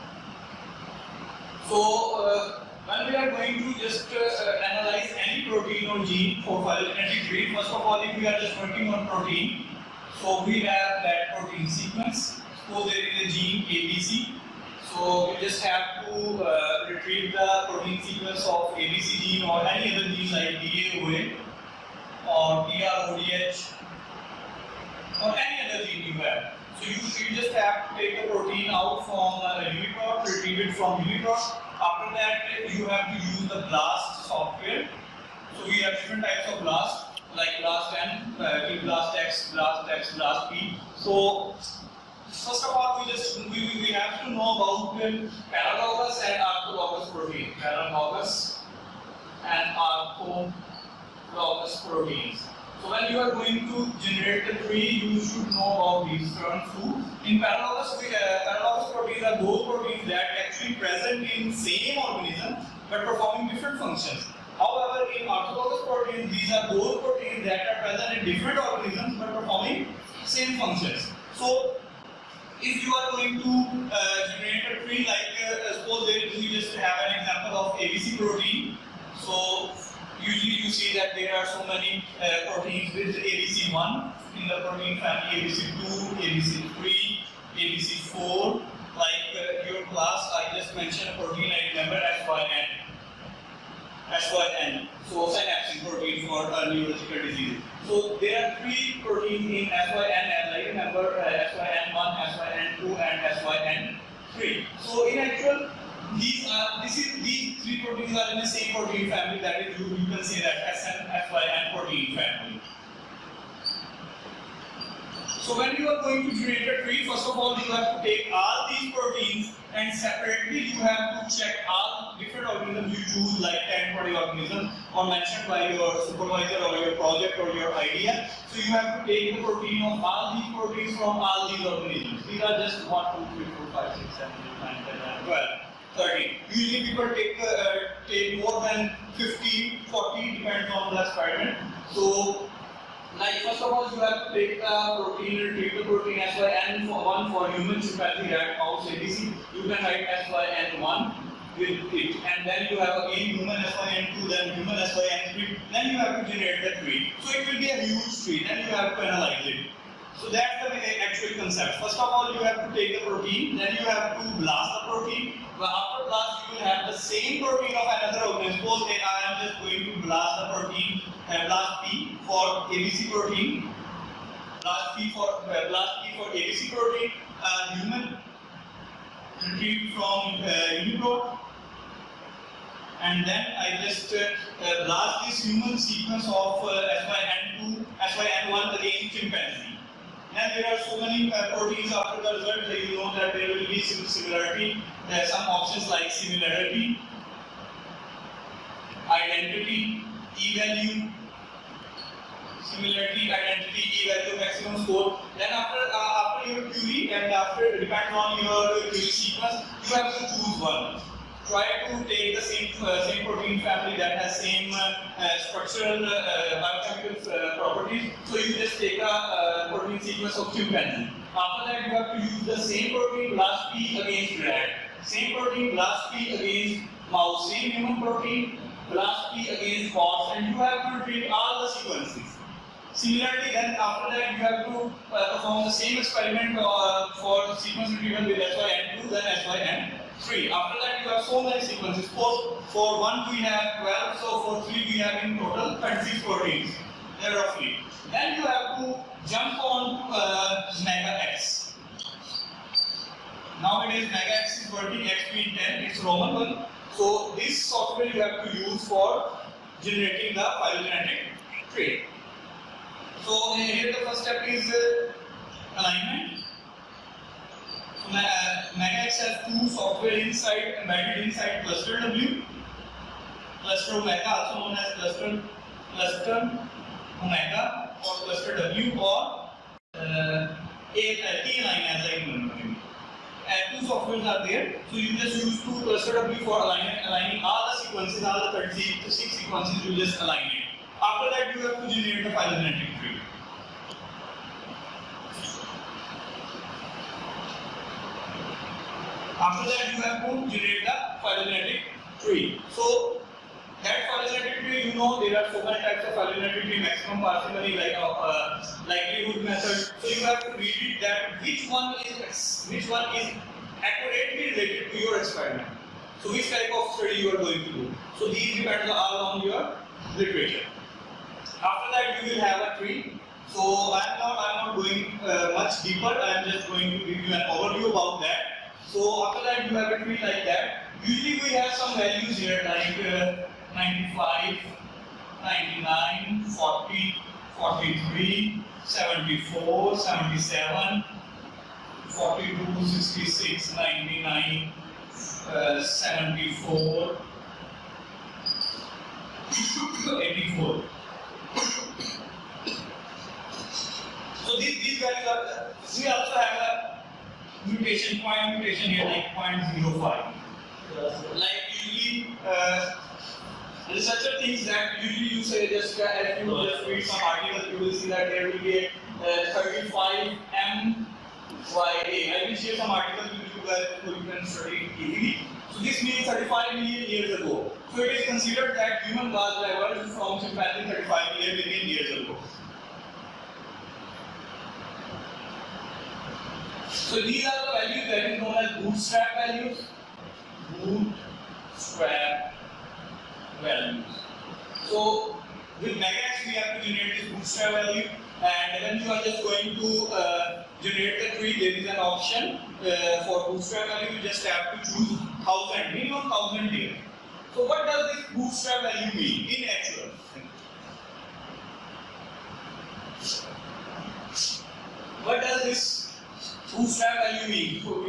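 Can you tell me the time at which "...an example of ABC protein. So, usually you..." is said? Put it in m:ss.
1:17.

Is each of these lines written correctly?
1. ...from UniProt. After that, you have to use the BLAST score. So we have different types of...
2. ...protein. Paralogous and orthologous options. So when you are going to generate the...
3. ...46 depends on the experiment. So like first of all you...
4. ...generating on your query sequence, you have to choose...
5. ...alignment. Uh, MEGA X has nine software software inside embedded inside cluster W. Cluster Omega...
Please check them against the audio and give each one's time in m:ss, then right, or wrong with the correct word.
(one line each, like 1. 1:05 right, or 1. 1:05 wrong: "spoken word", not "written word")
1. 0:30 wrong: "software", not "score"
2. 0:47 wrong: "proteins", not "options"
3. 2:19 wrong: "40", not "46"
4. 3:27 wrong: "depending", not "generating"
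5. 4:25 wrong: "two", not "nine".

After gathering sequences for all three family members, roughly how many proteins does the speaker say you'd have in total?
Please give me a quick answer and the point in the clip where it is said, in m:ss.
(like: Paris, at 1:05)
36, at 4:05.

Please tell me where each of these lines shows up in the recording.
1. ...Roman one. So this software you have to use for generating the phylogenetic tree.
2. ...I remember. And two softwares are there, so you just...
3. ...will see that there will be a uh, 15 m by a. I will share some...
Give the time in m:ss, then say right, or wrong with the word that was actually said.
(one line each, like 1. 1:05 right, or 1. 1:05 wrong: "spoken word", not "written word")
1. 4:16 right
2. 4:42 right
3. 6:07 wrong: "35", not "15".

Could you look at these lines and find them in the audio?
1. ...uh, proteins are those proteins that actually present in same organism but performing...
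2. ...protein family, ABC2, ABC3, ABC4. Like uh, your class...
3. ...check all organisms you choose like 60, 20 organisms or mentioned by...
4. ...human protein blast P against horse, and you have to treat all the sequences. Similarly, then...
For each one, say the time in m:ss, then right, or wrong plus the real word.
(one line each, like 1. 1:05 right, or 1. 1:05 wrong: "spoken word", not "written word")
1. 0:58 right
2. 1:24 right
3. 2:01 wrong: "10", not "60"
4. 3:47 right.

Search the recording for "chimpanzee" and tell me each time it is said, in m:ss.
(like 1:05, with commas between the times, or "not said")
2:27, 3:09, 3:40, 6:20.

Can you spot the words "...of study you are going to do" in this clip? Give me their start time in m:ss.
5:16.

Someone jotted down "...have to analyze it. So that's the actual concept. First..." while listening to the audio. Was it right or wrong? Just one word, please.
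right.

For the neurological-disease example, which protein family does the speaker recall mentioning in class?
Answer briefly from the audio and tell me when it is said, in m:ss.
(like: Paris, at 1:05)
Synapsin, at 1:35.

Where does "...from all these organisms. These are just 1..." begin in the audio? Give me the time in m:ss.
2:10.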